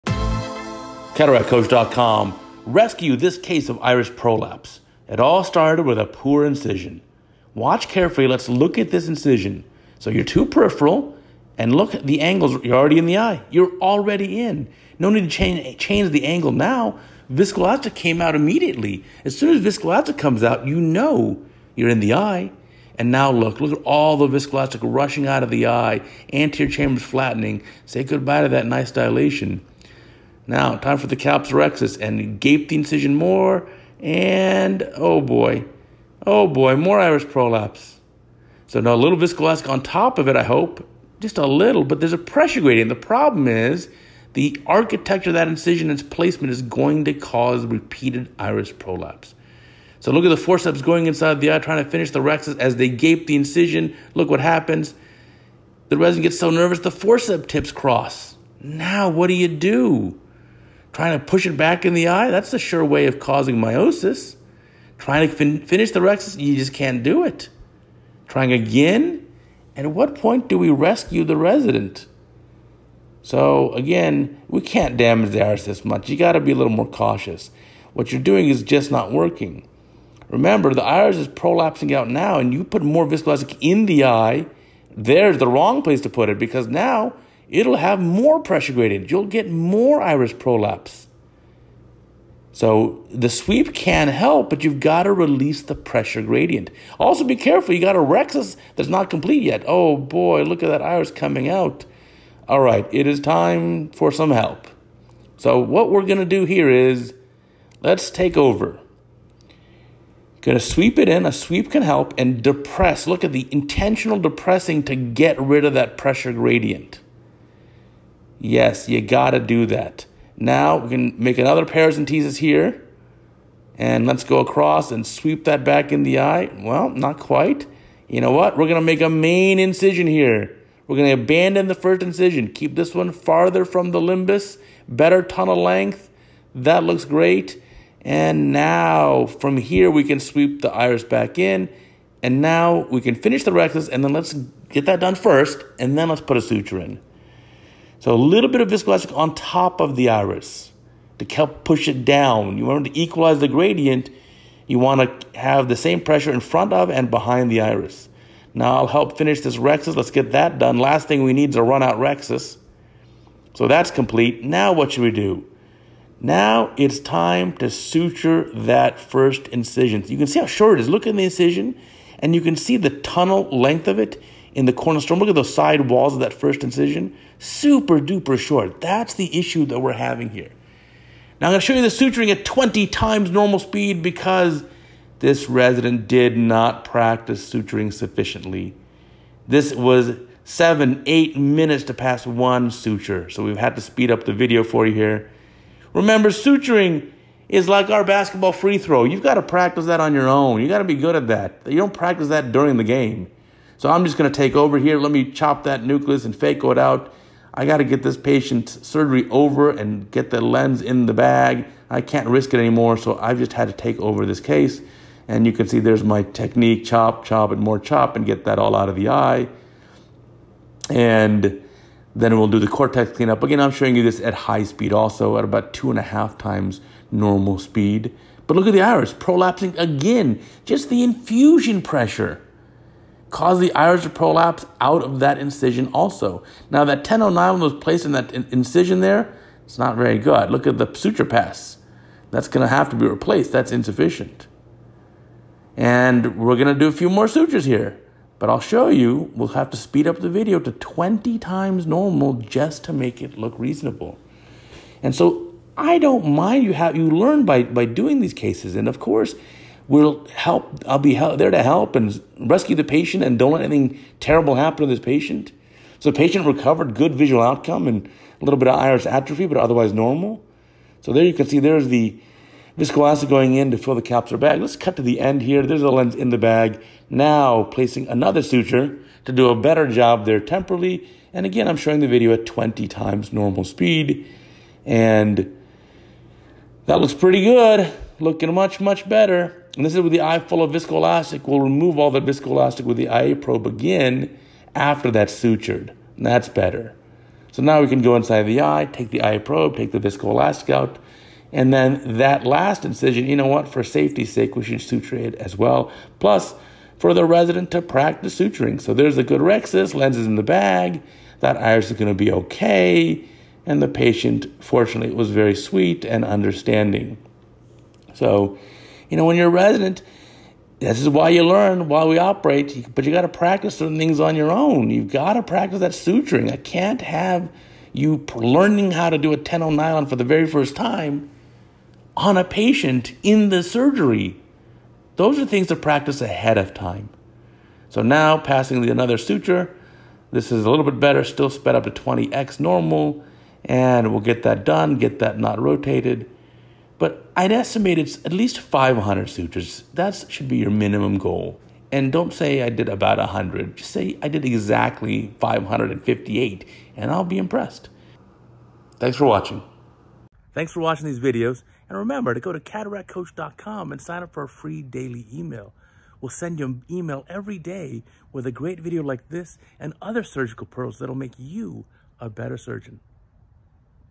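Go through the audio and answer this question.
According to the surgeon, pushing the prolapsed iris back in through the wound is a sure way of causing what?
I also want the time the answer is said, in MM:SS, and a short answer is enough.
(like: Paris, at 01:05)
Miosis, at 01:03.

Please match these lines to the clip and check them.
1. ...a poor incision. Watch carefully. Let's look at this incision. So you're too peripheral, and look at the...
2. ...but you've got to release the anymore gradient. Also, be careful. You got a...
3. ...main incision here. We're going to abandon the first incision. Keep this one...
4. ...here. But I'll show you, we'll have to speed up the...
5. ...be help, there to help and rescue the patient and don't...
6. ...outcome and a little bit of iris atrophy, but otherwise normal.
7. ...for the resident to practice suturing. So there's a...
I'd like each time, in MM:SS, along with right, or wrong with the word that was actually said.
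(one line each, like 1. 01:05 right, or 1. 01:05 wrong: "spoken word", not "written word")
1. 00:05 right
2. 01:34 wrong: "pressure", not "anymore"
3. 02:09 right
4. 04:07 right
5. 04:20 right
6. 04:27 right
7. 05:06 right.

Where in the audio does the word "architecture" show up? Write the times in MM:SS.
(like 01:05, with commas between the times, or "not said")
00:44.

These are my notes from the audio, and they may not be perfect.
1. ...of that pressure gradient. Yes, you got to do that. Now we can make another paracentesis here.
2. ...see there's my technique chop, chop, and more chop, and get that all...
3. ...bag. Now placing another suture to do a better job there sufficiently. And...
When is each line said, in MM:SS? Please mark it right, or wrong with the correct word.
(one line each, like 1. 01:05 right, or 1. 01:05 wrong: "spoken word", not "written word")
1. 01:55 right
2. 03:35 right
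3. 04:36 wrong: "temporally", not "sufficiently".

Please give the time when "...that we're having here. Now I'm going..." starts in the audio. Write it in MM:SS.
02:59.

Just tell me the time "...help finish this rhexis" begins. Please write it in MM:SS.
02:38.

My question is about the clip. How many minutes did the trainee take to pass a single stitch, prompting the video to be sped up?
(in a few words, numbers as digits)
7 to 8 minutes.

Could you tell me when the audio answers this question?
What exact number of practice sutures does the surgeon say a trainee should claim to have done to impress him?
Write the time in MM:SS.
05:54.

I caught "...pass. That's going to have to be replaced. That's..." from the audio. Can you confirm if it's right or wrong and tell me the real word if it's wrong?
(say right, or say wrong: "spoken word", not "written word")
right.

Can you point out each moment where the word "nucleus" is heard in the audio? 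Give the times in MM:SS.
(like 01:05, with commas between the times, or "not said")
03:25.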